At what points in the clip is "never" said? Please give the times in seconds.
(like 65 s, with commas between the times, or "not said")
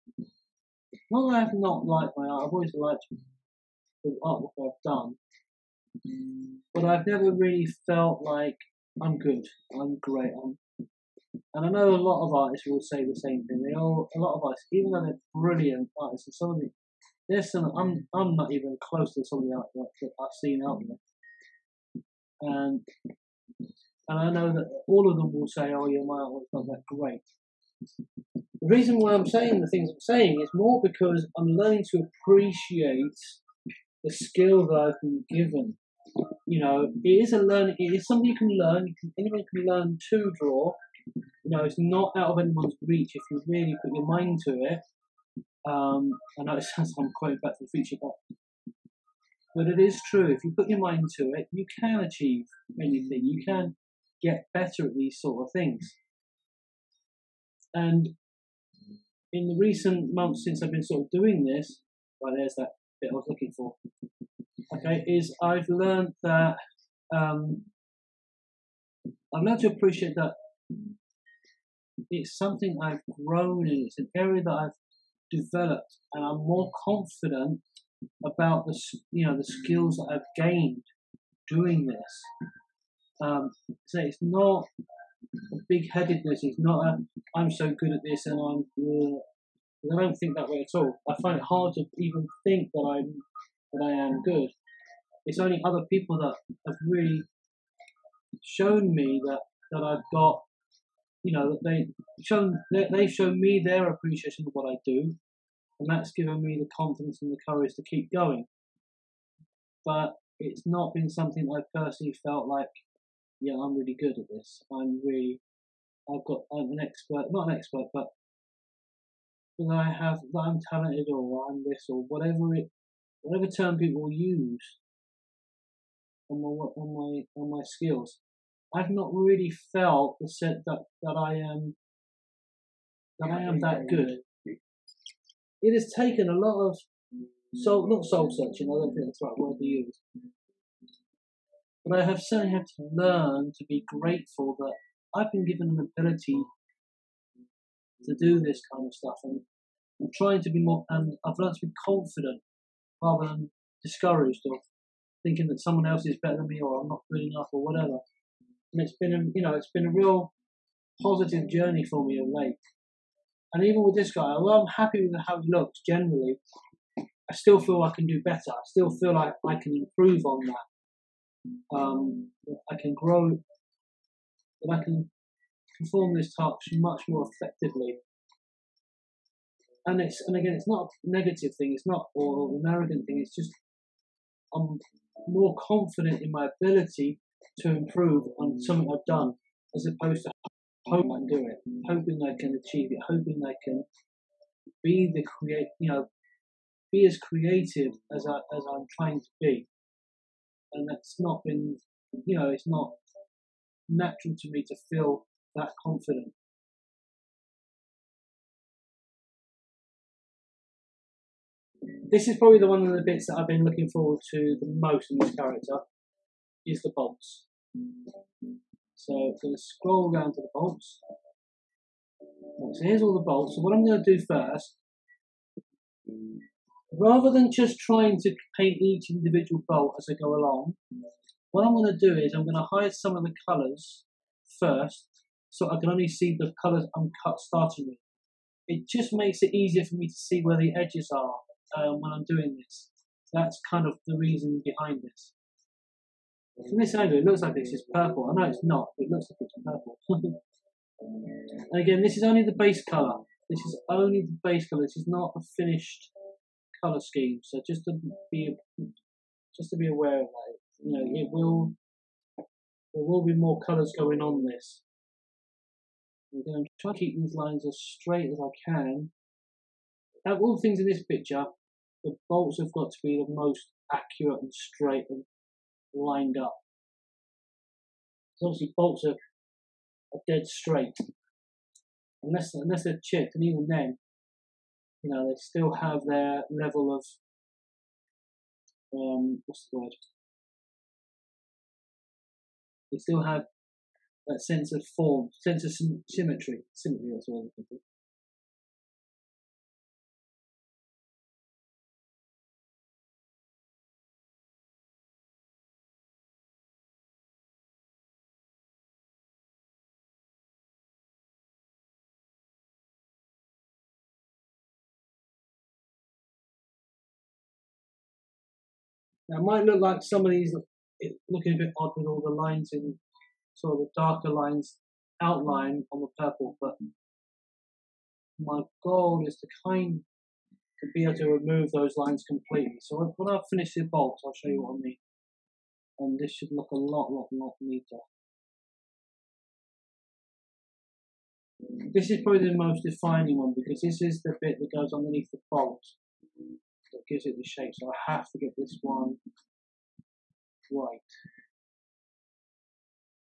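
7 s.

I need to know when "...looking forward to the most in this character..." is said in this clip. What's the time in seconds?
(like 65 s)
213 s.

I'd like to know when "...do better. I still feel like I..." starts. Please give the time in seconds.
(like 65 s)
168 s.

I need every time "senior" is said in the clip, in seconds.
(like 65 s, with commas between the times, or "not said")
not said.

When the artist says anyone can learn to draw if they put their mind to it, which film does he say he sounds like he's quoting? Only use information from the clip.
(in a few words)
Back to the Future.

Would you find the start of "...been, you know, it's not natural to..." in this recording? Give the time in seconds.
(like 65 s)
201 s.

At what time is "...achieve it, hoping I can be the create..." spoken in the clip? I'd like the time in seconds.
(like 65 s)
192 s.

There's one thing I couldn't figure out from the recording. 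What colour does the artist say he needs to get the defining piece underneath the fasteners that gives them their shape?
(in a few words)
White.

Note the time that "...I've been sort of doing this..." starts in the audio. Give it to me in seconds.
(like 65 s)
60 s.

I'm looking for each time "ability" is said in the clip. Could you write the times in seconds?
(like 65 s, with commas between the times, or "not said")
145 s, 186 s.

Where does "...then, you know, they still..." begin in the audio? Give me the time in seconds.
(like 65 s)
283 s.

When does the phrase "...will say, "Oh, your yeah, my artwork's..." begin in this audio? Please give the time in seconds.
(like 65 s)
25 s.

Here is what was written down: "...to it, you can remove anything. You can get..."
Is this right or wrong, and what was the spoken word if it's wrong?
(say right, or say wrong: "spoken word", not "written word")
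wrong: "achieve", not "remove".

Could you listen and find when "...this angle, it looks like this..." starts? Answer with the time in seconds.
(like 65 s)
246 s.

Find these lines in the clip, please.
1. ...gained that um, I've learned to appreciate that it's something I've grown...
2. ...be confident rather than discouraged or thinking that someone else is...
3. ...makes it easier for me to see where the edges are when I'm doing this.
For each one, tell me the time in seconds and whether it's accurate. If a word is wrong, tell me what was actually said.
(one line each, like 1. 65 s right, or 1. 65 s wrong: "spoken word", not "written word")
1. 65 s wrong: "learned", not "gained"
2. 151 s right
3. 239 s right.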